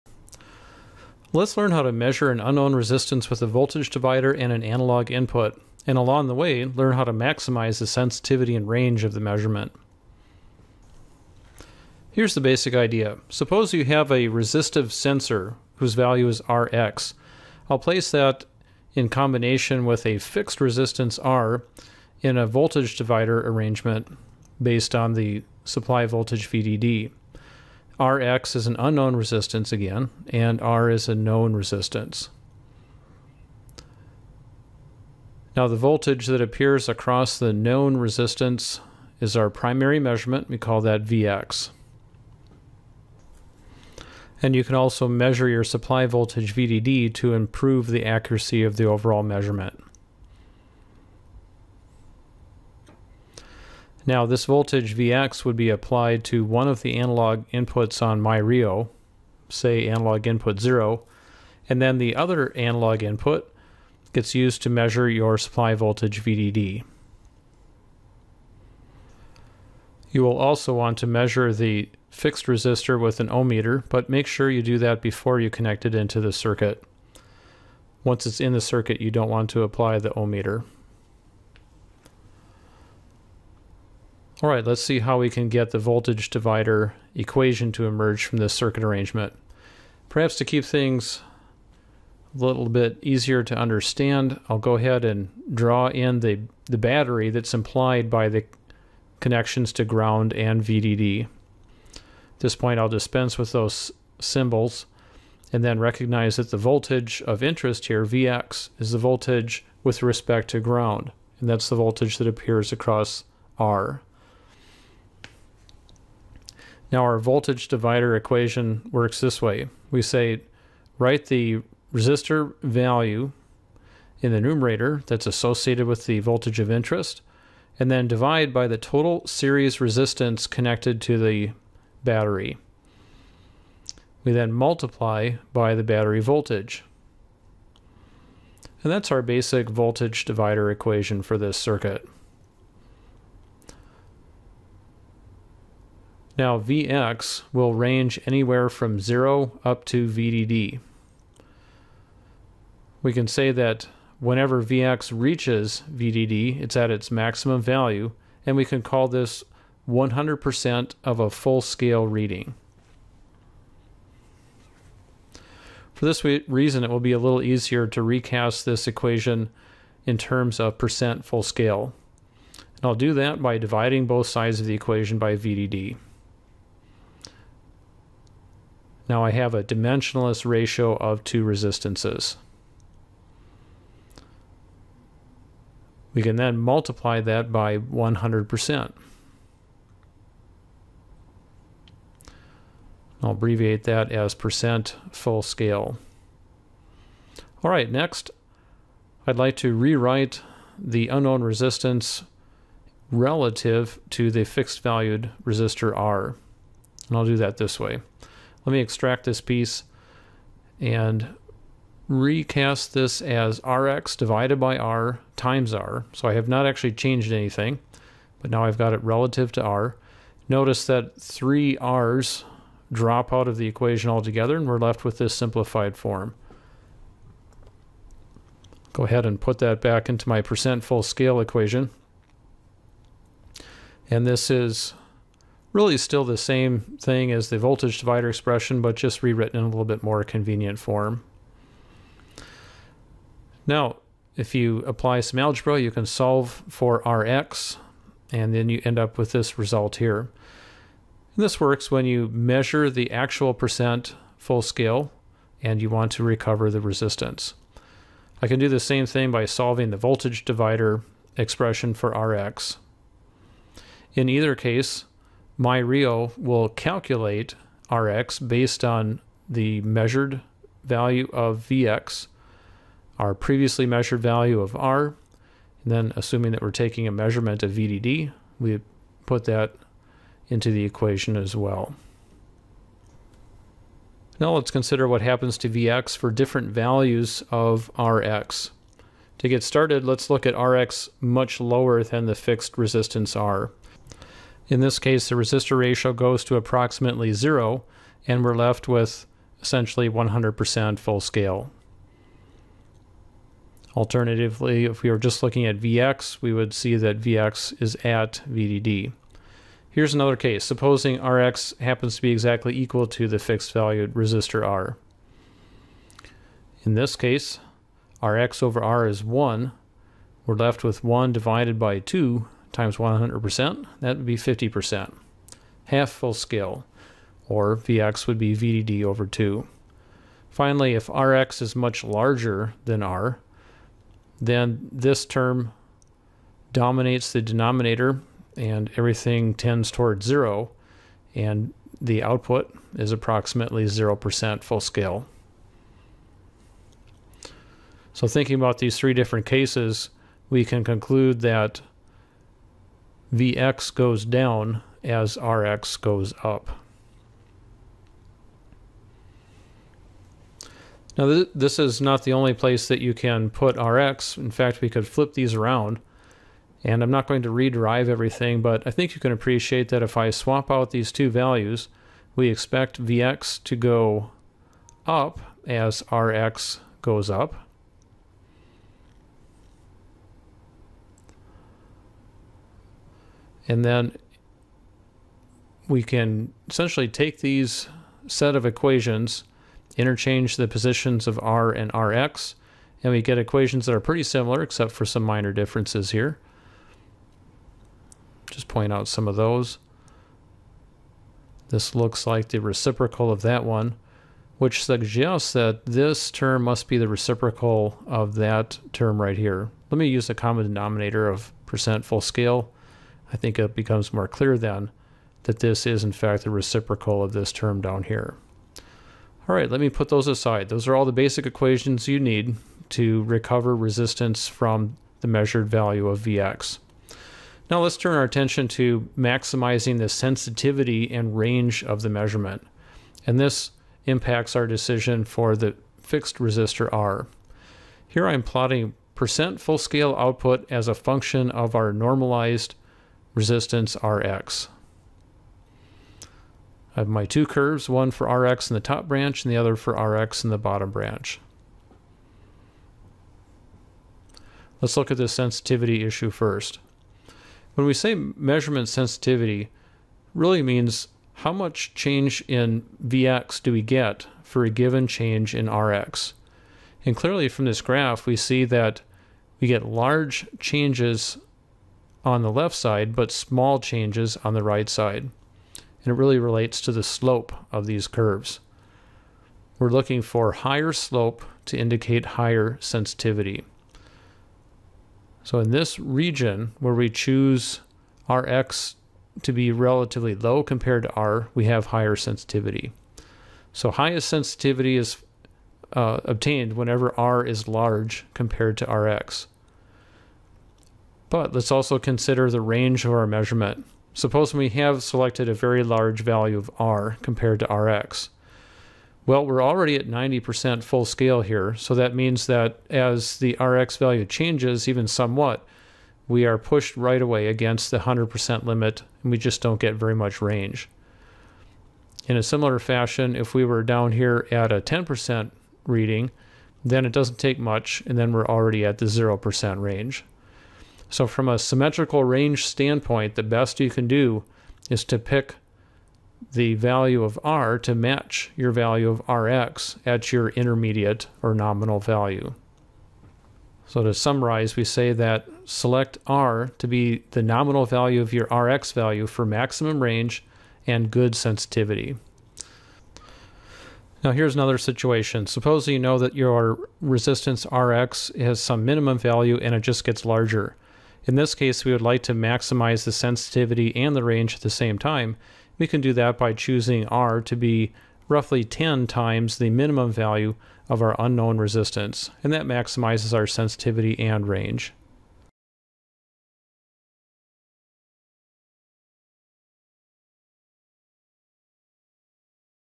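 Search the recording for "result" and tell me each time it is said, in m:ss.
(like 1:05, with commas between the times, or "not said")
4:09.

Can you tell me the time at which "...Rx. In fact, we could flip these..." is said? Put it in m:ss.
6:03.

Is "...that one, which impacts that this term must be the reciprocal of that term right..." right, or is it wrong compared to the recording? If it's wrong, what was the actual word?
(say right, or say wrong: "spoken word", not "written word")
wrong: "suggests", not "impacts".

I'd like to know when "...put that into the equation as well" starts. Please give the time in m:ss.
4:39.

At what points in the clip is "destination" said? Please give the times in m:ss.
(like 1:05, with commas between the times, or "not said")
not said.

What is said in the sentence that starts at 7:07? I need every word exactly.
Now let's turn our attention to maximizing the sensitivity and range of the measurement.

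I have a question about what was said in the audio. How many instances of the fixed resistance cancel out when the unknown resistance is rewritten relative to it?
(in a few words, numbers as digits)
3.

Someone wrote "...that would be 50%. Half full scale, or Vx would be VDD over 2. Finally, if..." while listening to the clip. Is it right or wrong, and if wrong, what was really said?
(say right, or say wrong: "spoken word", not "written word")
right.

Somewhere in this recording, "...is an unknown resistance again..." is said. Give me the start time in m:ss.
0:28.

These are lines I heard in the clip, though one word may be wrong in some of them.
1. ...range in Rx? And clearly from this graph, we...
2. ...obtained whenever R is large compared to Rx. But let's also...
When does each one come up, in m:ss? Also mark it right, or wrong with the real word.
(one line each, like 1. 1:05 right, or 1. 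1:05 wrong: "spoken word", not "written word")
1. 7:45 wrong: "change", not "range"
2. 8:16 right.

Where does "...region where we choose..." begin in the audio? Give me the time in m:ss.
8:05.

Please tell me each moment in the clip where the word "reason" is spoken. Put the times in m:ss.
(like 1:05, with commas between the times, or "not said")
2:46.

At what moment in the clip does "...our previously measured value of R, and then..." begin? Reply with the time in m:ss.
4:33.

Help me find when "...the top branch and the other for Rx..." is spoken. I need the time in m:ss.
7:28.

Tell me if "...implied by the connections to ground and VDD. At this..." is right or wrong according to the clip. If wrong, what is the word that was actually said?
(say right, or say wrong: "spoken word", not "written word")
right.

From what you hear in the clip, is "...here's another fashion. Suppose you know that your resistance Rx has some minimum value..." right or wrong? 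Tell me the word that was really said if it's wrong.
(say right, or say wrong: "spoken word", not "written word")
wrong: "situation", not "fashion".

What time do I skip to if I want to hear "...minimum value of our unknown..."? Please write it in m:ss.
9:29.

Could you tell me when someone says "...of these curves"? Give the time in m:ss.
7:57.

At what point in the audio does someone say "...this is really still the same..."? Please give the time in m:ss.
3:54.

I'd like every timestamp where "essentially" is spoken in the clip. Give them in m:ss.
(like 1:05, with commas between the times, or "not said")
4:59, 6:26.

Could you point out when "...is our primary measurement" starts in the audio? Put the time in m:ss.
0:39.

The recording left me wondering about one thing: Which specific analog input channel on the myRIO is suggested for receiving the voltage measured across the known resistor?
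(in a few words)
analog input 0.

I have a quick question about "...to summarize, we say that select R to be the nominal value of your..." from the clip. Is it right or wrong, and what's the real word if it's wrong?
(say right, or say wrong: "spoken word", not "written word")
right.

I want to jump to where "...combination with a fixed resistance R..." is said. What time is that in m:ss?
0:19.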